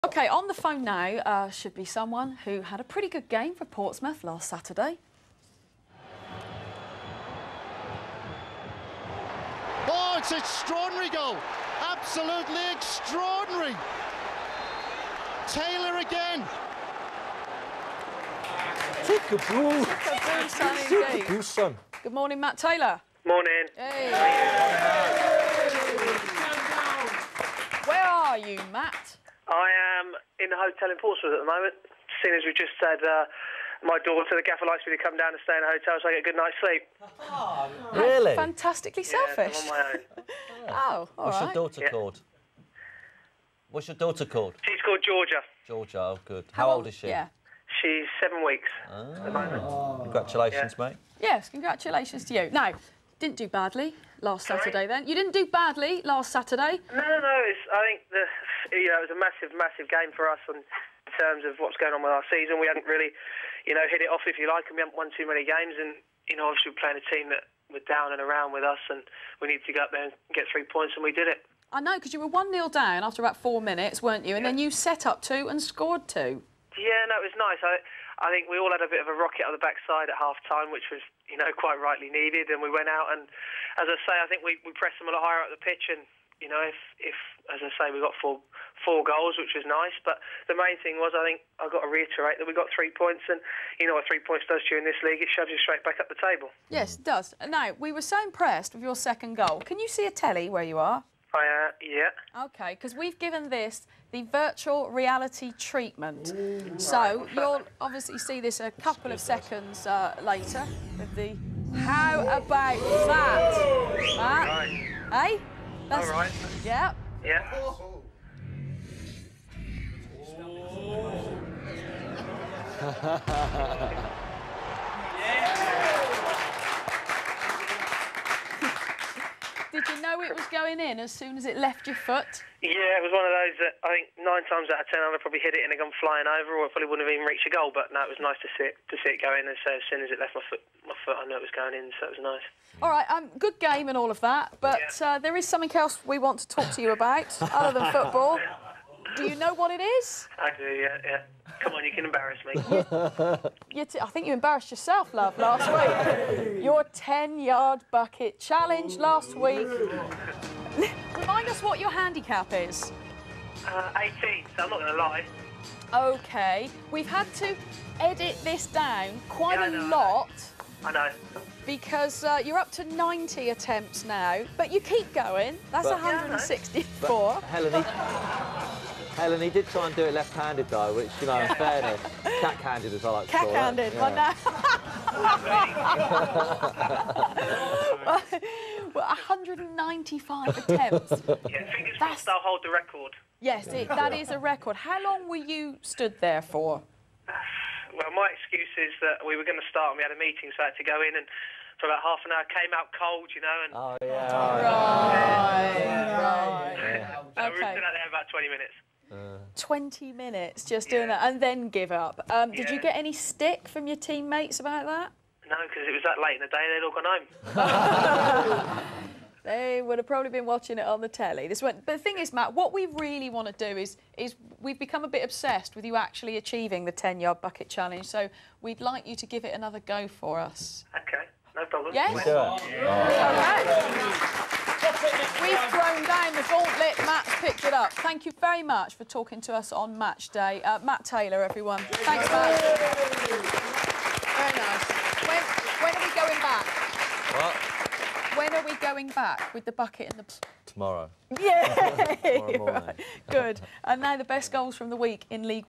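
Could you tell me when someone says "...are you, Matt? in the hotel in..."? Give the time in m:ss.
0:28.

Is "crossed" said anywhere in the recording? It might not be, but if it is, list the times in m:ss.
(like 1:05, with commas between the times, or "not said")
3:11.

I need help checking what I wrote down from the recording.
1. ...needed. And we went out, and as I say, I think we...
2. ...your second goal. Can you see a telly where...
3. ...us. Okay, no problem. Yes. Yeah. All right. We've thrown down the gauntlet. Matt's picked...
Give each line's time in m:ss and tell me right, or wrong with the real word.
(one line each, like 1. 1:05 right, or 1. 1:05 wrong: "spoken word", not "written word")
1. 1:22 right
2. 1:38 right
3. 3:50 right.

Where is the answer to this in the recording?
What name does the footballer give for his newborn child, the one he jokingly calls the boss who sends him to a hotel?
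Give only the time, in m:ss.
0:44.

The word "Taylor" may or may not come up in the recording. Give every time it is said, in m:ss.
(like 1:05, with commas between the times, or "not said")
0:15, 0:22, 4:01.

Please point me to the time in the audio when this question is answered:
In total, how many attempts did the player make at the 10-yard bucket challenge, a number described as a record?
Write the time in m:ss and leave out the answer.
3:09.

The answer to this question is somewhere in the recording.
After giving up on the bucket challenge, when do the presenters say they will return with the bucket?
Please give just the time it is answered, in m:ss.
4:12.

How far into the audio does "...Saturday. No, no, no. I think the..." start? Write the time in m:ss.
0:56.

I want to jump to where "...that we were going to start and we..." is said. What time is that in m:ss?
3:19.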